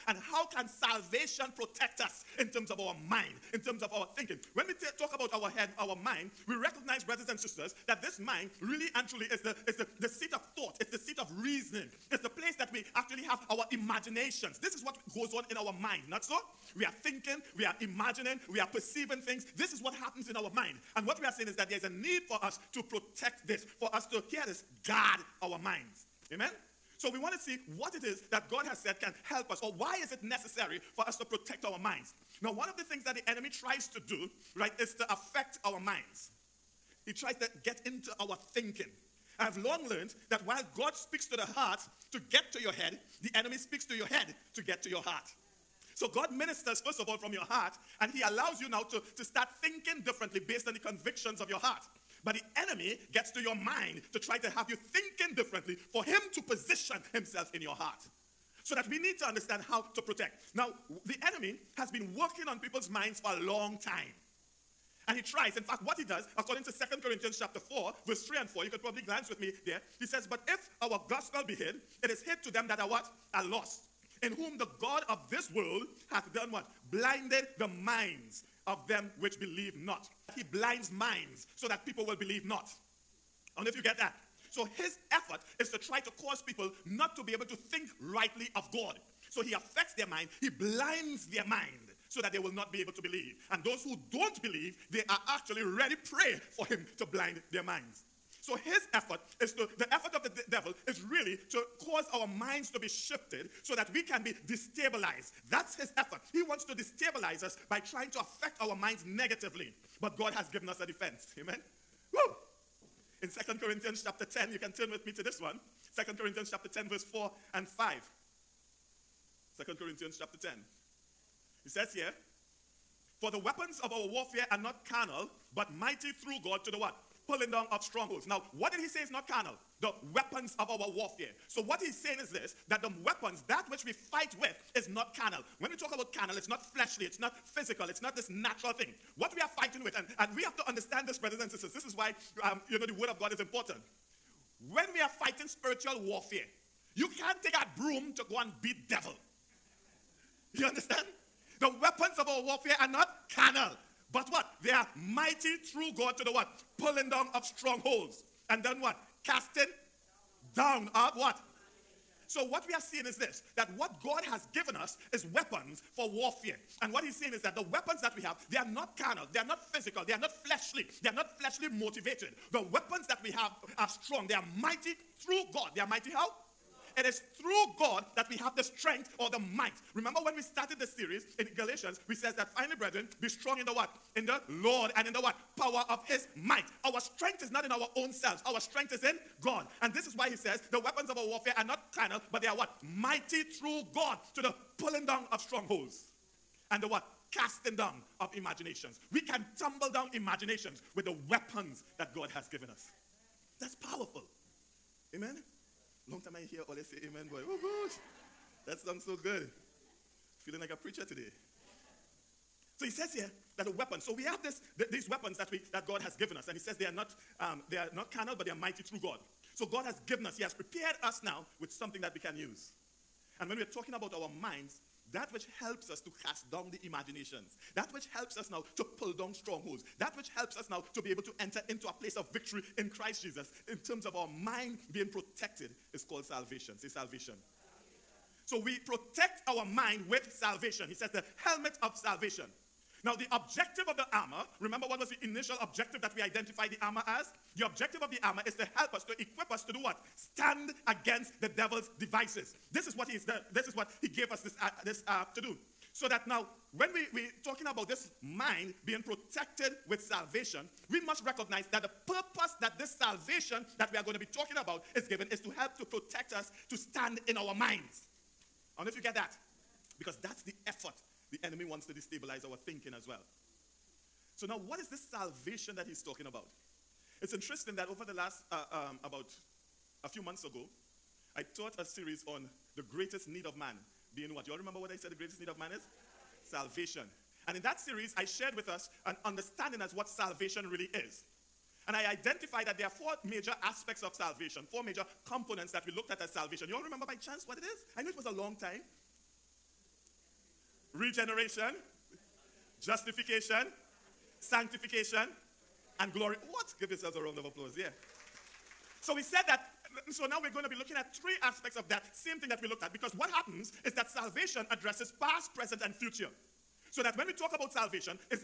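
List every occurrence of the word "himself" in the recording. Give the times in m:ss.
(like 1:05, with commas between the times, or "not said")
0:57.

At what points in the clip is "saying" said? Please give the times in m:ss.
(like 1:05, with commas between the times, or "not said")
0:21, 2:11, 2:47.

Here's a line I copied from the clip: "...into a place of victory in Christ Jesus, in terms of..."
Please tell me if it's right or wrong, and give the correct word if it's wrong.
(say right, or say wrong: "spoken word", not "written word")
right.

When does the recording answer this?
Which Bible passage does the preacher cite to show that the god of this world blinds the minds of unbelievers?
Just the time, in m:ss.
1:06.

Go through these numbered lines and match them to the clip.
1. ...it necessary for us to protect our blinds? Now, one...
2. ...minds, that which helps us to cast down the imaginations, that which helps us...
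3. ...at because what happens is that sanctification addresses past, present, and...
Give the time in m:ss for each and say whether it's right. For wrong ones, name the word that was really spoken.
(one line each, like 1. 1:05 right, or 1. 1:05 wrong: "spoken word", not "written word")
1. 0:30 wrong: "minds", not "blinds"
2. 3:44 right
3. 5:12 wrong: "salvation", not "sanctification".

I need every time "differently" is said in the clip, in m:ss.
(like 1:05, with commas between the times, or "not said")
0:50, 0:55.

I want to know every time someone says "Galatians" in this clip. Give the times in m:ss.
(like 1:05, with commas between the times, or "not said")
3:01.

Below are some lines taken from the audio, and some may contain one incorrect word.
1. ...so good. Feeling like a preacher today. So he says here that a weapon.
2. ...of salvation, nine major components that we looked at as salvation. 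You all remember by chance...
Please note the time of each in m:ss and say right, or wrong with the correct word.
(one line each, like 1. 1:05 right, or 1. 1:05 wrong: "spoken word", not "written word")
1. 3:29 right
2. 4:54 wrong: "four", not "nine".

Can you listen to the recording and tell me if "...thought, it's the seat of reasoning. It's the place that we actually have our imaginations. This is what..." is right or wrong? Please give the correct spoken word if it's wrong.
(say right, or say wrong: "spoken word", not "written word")
right.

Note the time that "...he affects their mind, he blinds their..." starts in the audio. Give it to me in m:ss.
1:29.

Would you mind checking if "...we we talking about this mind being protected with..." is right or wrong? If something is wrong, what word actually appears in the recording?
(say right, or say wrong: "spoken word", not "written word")
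right.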